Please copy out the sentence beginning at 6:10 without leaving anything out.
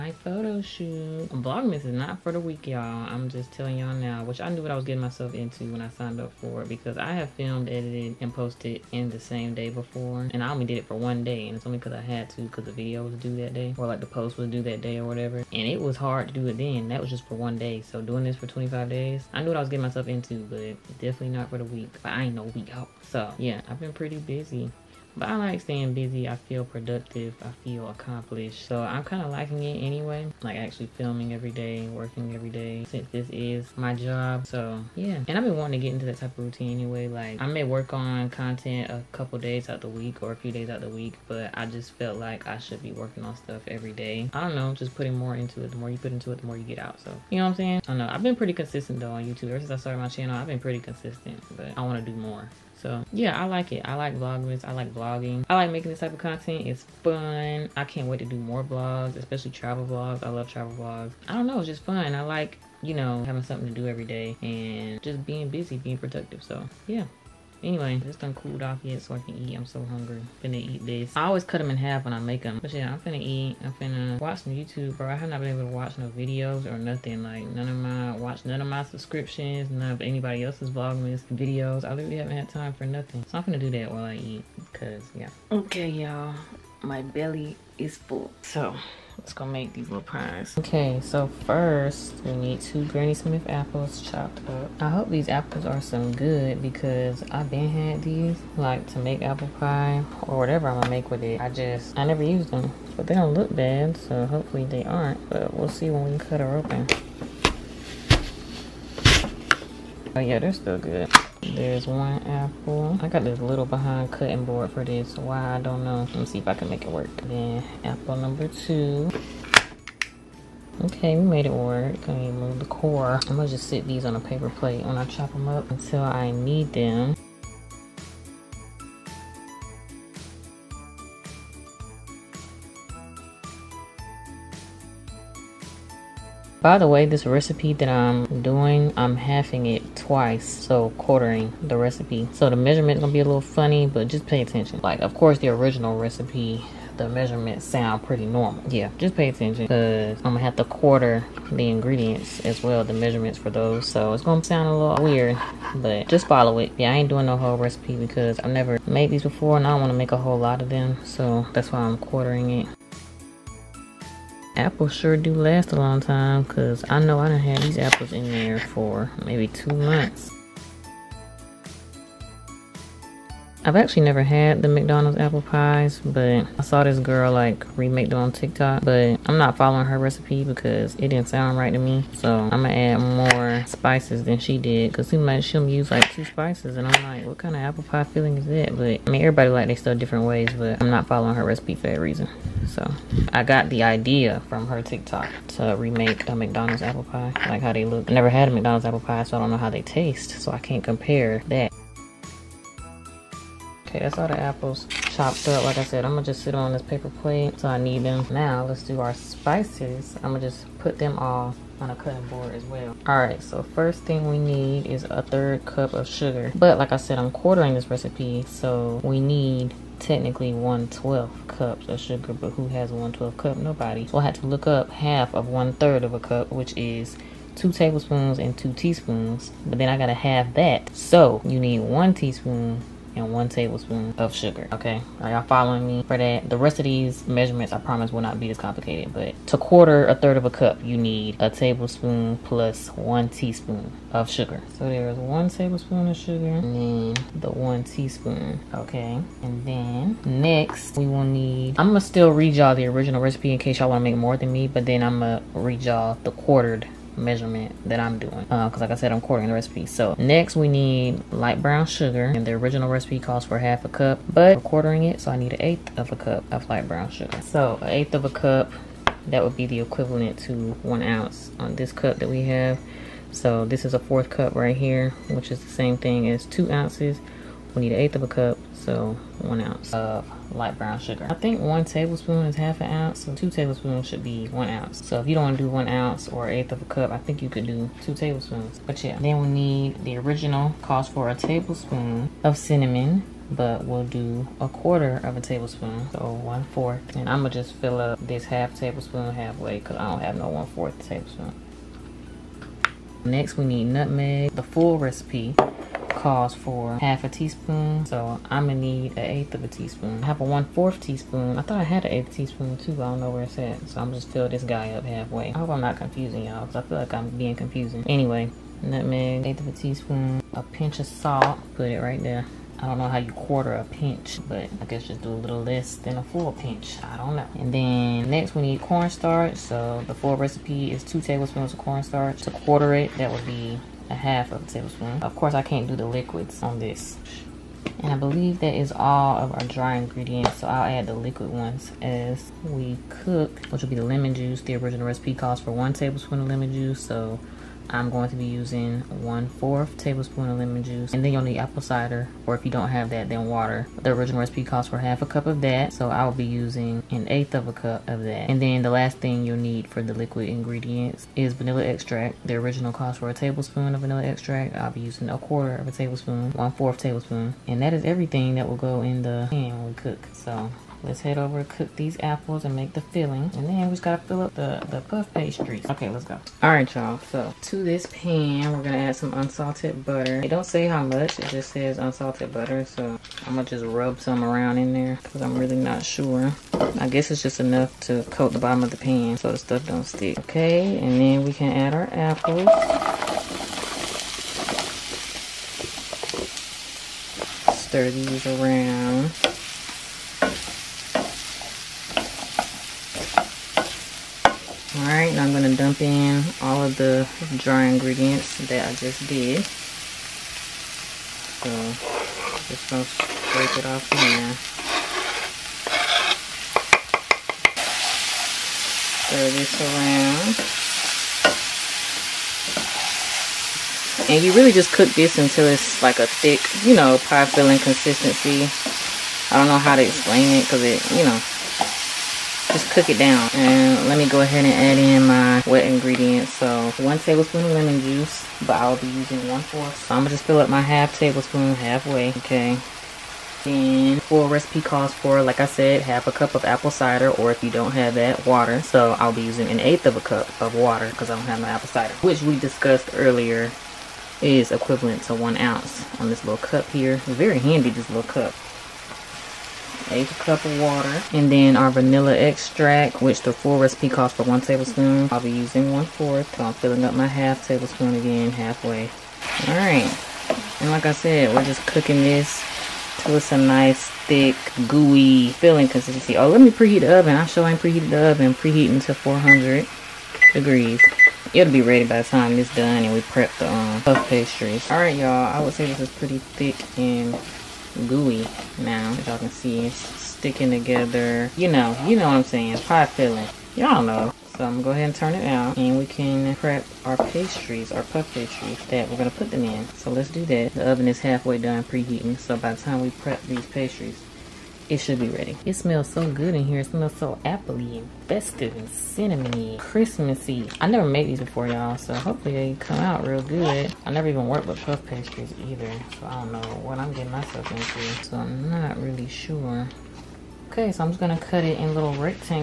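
So Let's head over, cook these apples and make the filling.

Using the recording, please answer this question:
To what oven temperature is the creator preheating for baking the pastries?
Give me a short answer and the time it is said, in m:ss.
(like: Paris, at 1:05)
400 degrees, at 7:59.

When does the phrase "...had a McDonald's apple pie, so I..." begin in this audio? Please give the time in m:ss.
3:18.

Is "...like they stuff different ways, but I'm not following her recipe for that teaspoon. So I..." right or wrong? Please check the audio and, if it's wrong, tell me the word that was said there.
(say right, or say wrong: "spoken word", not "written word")
wrong: "reason", not "teaspoon".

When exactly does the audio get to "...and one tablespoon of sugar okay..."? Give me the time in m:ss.
3:53.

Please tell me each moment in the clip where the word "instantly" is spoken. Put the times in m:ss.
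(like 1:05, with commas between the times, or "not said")
not said.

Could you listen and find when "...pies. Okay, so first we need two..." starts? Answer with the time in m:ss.
1:30.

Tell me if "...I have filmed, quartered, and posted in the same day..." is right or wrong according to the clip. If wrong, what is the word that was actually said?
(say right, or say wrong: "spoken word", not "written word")
wrong: "edited", not "quartered".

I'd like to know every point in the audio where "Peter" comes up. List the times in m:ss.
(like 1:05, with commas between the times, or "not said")
not said.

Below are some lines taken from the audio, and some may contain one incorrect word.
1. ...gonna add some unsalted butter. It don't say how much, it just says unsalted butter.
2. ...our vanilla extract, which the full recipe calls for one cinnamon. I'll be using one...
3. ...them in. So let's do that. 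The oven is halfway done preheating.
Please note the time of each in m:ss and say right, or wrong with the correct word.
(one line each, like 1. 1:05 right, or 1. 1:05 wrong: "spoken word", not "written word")
1. 6:18 right
2. 7:41 wrong: "tablespoon", not "cinnamon"
3. 8:19 right.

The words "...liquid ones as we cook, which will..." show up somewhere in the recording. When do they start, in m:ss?
5:41.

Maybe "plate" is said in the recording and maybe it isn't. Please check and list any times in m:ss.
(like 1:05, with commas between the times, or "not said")
2:04, 3:27.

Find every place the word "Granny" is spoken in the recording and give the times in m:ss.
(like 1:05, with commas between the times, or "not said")
1:32.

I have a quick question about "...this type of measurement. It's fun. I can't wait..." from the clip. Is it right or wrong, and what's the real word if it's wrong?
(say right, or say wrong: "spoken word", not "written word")
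wrong: "content", not "measurement".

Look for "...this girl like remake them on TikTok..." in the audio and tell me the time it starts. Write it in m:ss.
2:56.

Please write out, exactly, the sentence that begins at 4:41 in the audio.
I think one tablespoon is half an ounce, so two tablespoons should be one ounce.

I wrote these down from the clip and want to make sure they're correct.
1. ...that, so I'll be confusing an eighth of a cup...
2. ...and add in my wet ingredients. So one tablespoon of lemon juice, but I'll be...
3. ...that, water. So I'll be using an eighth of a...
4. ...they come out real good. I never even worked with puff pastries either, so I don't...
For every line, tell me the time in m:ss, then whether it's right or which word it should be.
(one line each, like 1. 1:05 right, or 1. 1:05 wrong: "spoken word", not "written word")
1. 5:55 wrong: "using", not "confusing"
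2. 7:14 right
3. 7:28 right
4. 8:32 right.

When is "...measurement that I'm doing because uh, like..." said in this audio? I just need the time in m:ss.
4:17.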